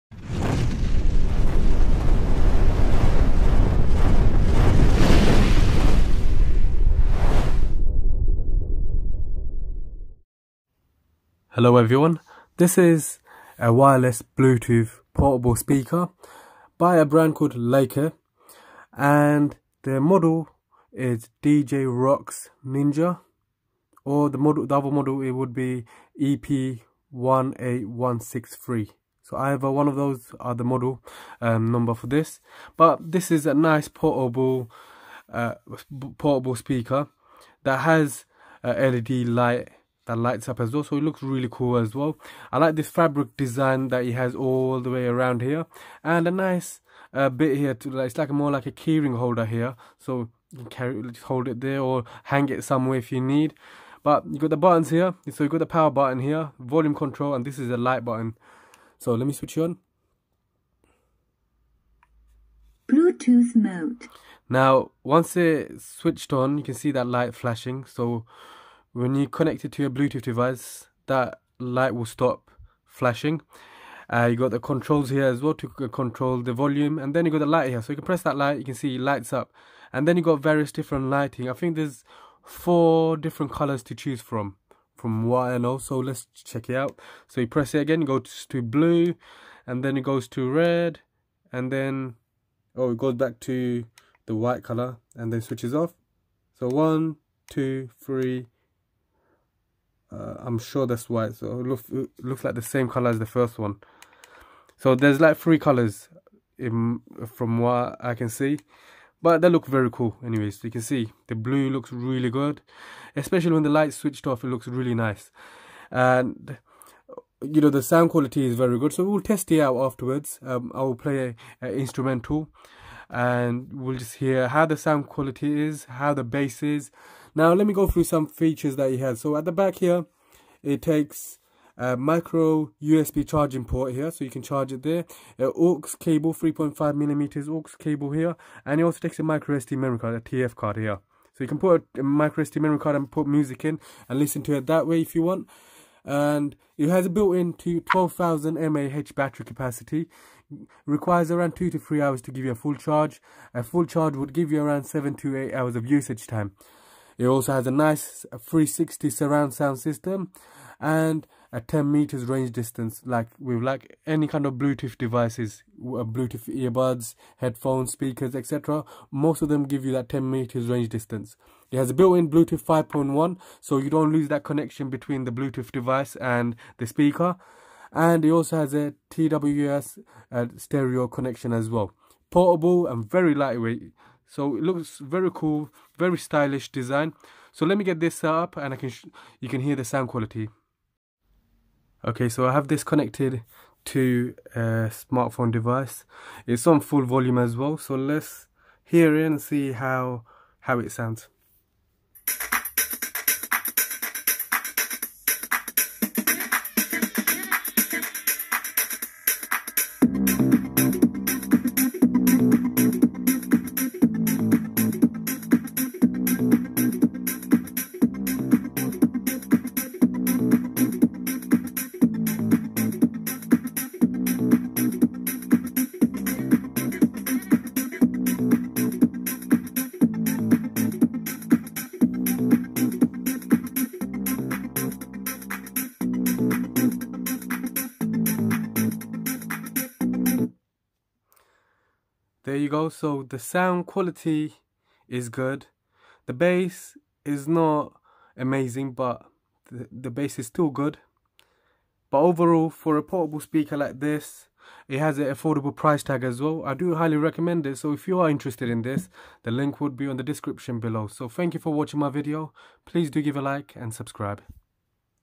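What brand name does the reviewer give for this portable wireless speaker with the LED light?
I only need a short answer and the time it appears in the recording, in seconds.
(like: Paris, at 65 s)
Leicke, at 17 s.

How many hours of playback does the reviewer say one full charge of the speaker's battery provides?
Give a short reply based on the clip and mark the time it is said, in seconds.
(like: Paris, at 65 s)
7 to 8 hours, at 154 s.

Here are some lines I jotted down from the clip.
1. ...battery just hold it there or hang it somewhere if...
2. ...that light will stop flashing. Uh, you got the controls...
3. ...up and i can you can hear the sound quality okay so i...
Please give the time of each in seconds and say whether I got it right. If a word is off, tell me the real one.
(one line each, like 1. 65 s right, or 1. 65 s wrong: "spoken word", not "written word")
1. 50 s wrong: "carry", not "battery"
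2. 71 s right
3. 188 s right.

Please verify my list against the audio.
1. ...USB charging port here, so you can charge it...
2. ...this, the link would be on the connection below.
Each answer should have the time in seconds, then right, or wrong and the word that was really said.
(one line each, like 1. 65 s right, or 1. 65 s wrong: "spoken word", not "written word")
1. 132 s right
2. 258 s wrong: "description", not "connection".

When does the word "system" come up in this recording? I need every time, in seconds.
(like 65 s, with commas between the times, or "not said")
159 s.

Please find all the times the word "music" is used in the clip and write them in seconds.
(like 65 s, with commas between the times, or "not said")
143 s.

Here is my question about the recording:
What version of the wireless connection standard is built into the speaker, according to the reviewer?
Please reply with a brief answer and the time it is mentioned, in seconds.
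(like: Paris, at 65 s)
5.1, at 172 s.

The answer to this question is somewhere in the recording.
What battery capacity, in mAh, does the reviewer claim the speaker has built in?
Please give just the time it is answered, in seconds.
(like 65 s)
147 s.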